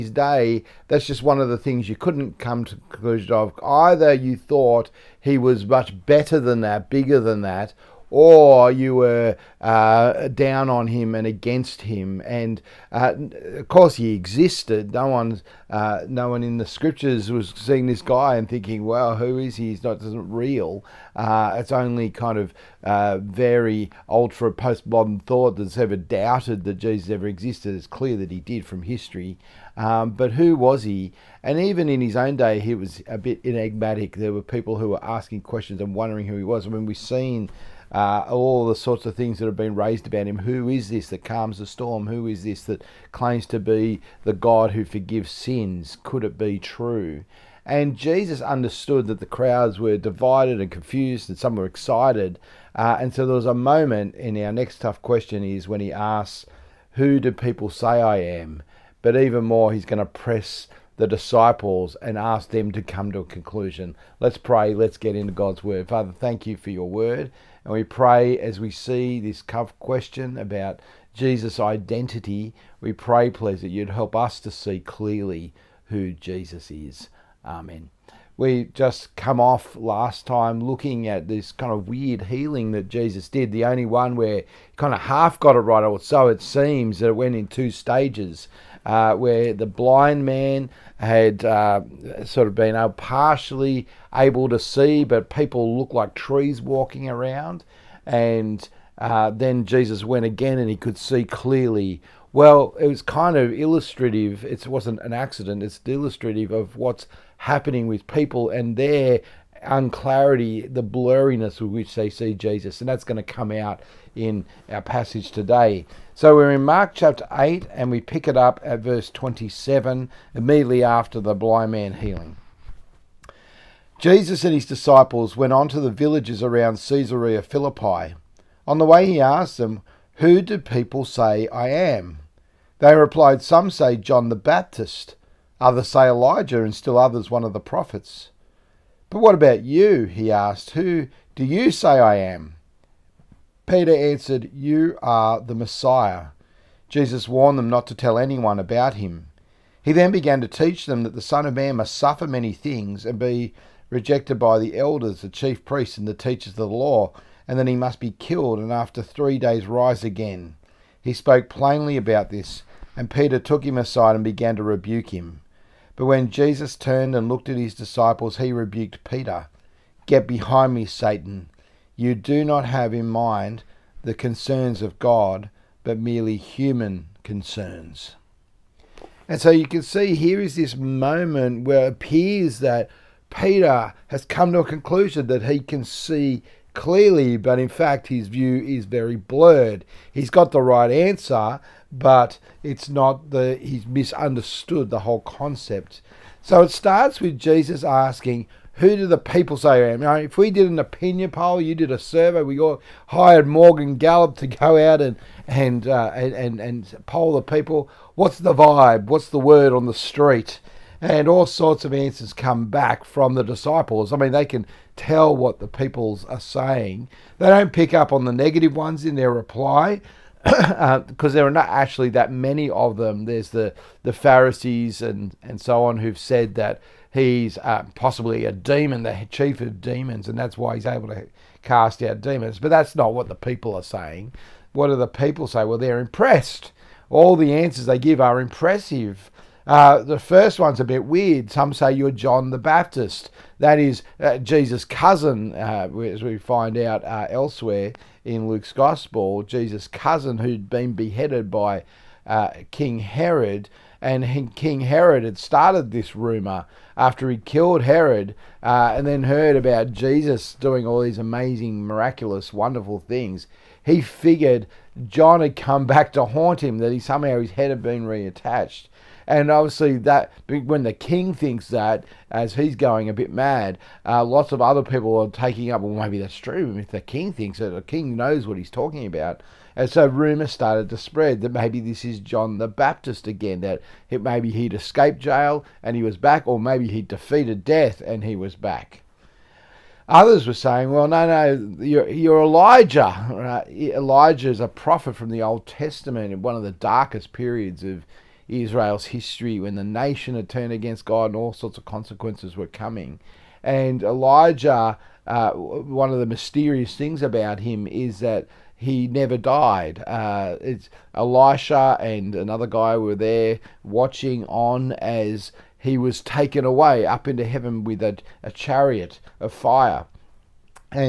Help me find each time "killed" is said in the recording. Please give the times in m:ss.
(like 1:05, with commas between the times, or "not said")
2:38, 4:17.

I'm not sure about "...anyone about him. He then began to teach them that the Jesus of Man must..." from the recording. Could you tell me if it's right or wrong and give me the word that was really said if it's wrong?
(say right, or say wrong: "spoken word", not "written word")
wrong: "Son", not "Jesus".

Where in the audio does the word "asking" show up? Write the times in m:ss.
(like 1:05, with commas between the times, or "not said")
0:35, 3:17.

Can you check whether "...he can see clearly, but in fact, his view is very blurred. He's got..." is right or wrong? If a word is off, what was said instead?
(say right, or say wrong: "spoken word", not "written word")
right.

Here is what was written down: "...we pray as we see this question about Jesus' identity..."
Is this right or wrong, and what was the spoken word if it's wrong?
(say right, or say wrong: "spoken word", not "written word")
right.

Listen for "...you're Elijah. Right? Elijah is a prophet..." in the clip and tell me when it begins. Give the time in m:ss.
4:52.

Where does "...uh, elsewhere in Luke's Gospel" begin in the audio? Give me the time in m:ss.
4:07.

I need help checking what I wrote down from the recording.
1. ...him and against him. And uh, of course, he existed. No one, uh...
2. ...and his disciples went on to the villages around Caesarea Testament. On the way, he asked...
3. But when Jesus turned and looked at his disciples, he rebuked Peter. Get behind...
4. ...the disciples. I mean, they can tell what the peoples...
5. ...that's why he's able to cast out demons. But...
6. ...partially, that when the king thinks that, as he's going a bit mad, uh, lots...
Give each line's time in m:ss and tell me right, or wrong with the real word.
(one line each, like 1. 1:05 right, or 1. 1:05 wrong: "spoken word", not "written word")
1. 0:10 right
2. 2:04 wrong: "Philippi", not "Testament"
3. 2:45 right
4. 3:33 right
5. 3:50 right
6. 4:29 wrong: "obviously", not "partially".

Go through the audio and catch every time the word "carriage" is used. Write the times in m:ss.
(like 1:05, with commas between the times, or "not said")
not said.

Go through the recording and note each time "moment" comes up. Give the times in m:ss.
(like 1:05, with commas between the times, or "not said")
0:53, 3:00.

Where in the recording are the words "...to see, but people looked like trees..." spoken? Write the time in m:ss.
1:34.